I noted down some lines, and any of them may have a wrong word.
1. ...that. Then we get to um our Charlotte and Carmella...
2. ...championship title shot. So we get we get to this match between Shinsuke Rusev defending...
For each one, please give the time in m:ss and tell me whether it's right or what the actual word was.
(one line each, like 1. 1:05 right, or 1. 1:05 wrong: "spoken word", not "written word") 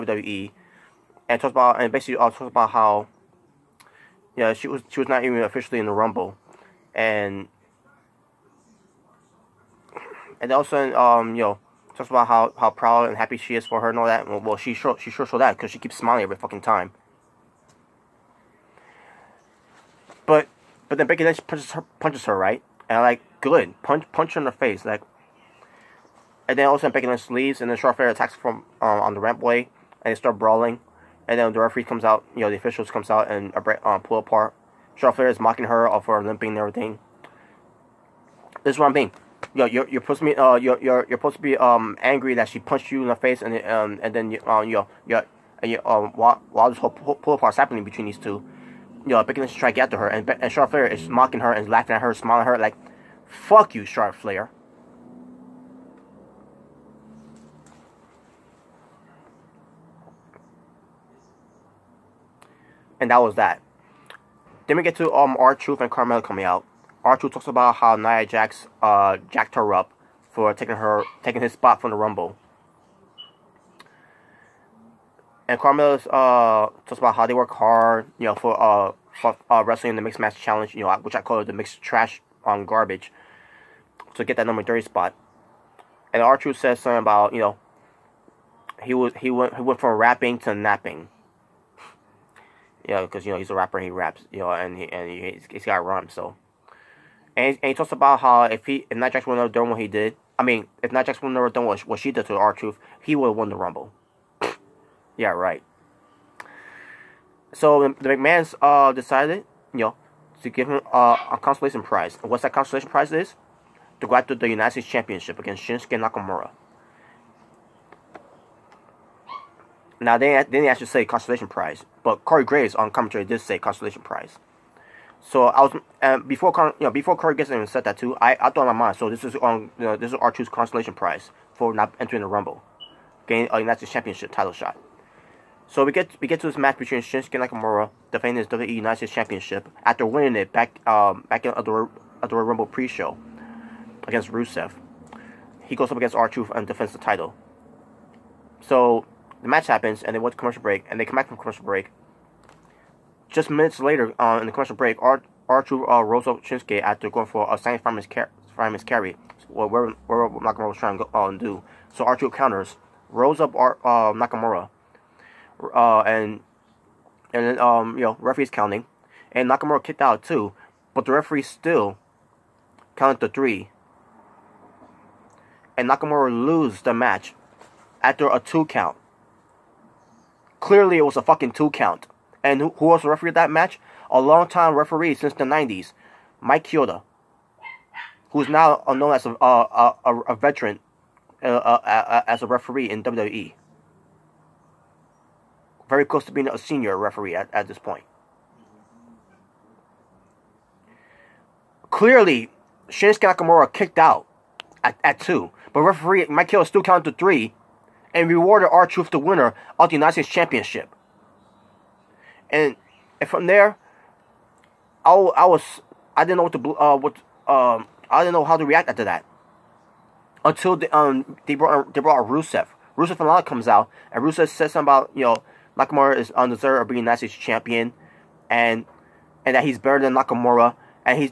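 1. 1:03 wrong: "Truth", not "Charlotte"
2. 2:13 wrong: "Nakamura", not "Rusev".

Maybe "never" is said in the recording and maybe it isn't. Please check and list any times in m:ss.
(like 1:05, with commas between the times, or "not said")
1:41.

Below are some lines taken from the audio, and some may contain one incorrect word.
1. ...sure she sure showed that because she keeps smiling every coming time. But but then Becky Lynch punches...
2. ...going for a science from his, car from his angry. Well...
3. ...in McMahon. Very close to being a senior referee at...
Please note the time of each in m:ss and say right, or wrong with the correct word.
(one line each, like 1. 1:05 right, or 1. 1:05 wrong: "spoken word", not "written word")
1. 0:14 wrong: "fucking", not "coming"
2. 2:37 wrong: "carry", not "angry"
3. 3:12 wrong: "WWE", not "McMahon".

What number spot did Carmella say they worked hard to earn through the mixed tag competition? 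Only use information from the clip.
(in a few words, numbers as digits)
30.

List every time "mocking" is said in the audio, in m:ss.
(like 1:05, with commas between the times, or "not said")
0:35, 0:51.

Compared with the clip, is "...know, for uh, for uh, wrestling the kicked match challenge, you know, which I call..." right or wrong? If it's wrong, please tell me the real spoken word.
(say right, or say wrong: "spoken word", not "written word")
wrong: "mixed", not "kicked".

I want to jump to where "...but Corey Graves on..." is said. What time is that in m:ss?
2:02.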